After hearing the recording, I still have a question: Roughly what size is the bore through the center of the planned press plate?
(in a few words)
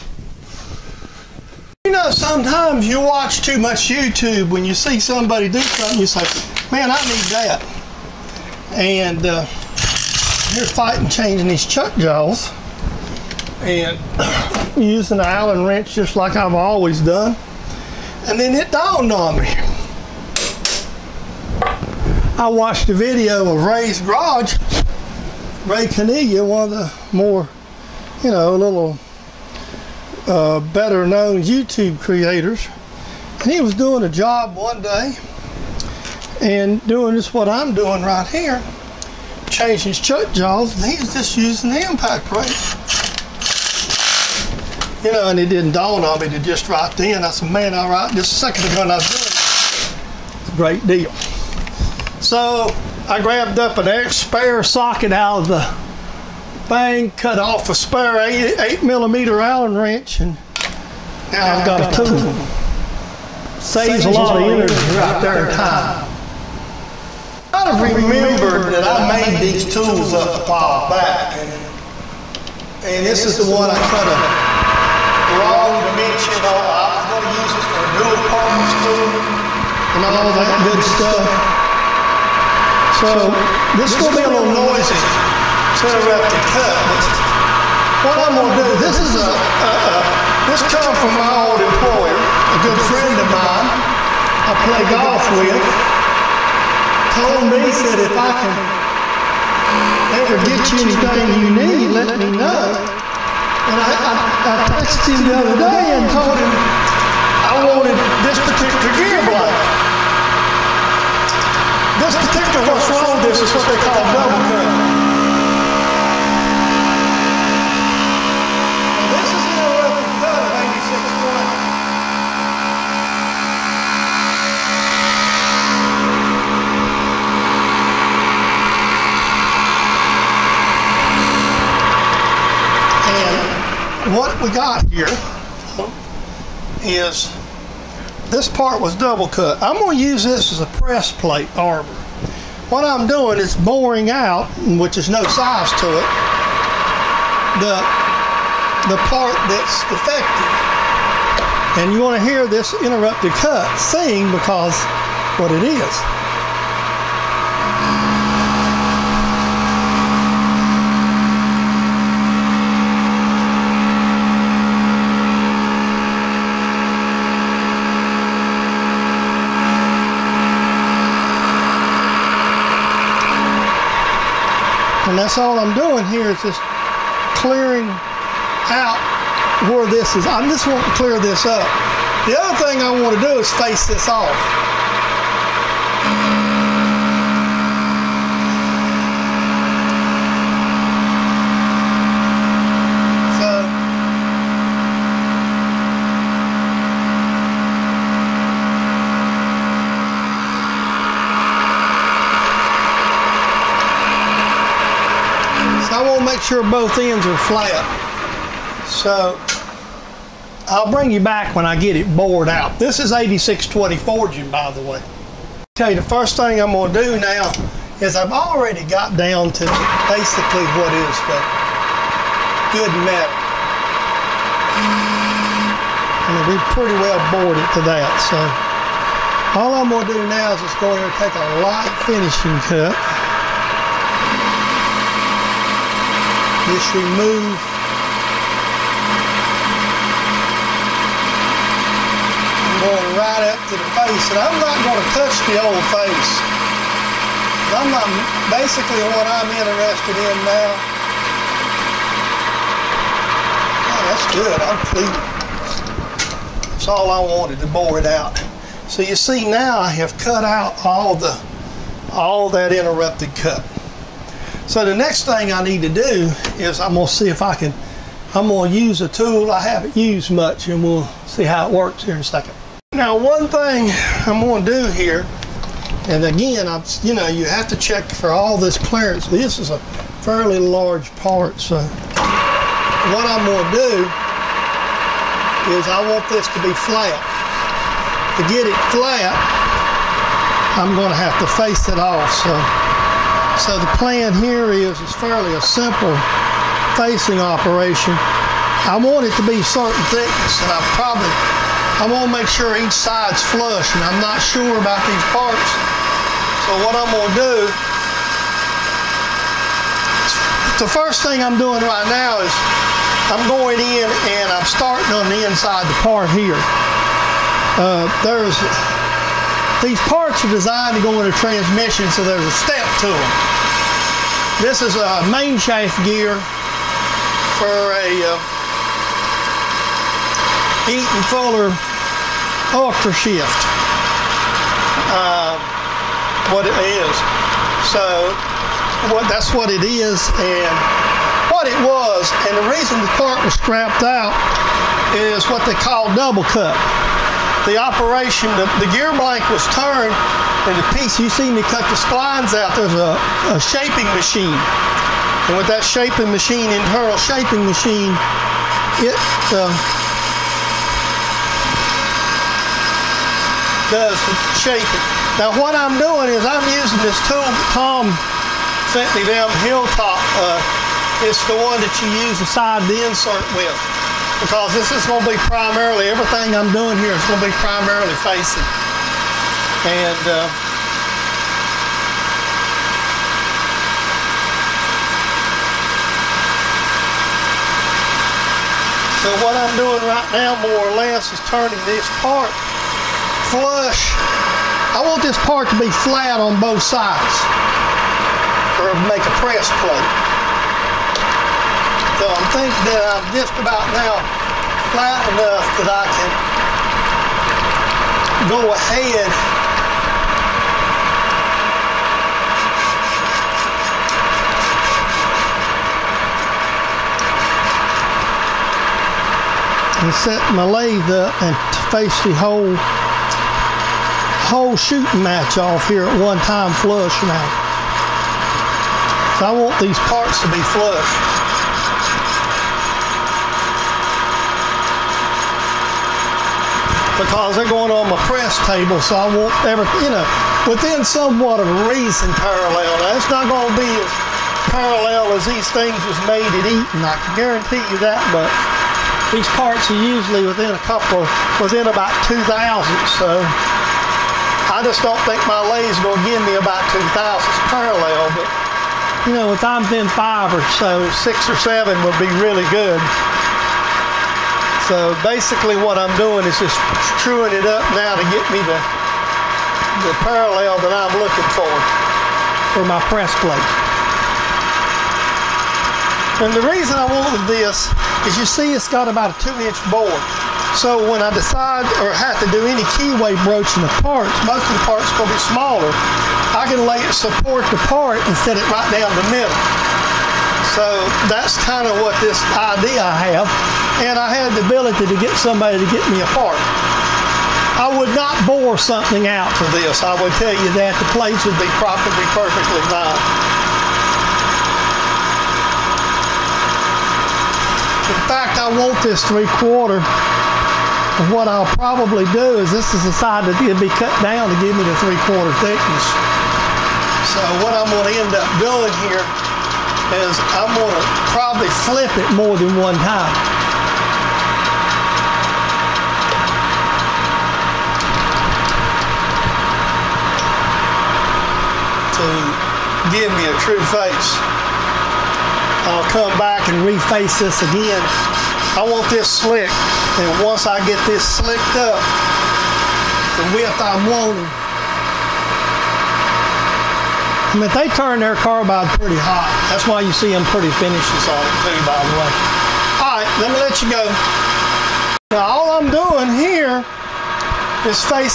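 2 inch.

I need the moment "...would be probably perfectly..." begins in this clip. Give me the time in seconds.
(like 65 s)
501 s.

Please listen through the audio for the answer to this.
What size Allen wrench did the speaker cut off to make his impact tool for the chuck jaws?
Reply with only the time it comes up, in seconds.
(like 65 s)
58 s.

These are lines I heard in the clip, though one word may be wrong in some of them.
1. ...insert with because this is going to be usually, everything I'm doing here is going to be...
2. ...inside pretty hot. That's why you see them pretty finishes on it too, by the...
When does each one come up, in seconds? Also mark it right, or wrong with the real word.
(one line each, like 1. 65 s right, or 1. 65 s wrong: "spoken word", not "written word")
1. 373 s wrong: "primarily", not "usually"
2. 548 s wrong: "carbide", not "inside".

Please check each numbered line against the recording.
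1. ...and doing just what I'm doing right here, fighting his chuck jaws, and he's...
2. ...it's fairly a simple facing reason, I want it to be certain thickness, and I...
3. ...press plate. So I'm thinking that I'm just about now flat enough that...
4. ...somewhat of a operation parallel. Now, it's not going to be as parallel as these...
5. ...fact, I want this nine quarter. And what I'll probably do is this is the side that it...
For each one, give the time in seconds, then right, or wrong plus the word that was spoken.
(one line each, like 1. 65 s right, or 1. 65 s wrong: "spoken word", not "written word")
1. 36 s wrong: "changing", not "fighting"
2. 295 s wrong: "operation", not "reason"
3. 399 s right
4. 441 s wrong: "reason", not "operation"
5. 508 s wrong: "three", not "nine".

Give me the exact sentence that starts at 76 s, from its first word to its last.
I was going to use it for a dual purpose tool and all that good stuff.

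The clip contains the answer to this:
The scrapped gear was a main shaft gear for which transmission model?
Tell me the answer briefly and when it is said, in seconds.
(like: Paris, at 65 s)
Eaton Fuller Ultra Shift, at 330 s.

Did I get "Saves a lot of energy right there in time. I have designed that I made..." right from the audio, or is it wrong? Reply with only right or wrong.
wrong.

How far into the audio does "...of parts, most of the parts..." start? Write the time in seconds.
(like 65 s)
483 s.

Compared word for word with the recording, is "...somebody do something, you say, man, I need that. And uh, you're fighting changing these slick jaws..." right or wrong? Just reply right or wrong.
wrong.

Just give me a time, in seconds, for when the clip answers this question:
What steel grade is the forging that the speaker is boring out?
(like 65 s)
213 s.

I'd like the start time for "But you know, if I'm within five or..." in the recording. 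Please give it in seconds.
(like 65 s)
458 s.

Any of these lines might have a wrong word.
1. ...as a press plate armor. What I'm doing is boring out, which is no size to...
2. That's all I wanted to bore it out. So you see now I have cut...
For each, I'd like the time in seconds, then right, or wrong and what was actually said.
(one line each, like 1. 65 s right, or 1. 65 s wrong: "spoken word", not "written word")
1. 140 s right
2. 256 s right.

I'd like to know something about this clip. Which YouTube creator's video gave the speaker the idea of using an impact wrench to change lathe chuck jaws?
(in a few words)
Ray Caniglia.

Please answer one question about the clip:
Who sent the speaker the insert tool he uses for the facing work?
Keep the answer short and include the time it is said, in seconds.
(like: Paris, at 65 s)
Tom, at 367 s.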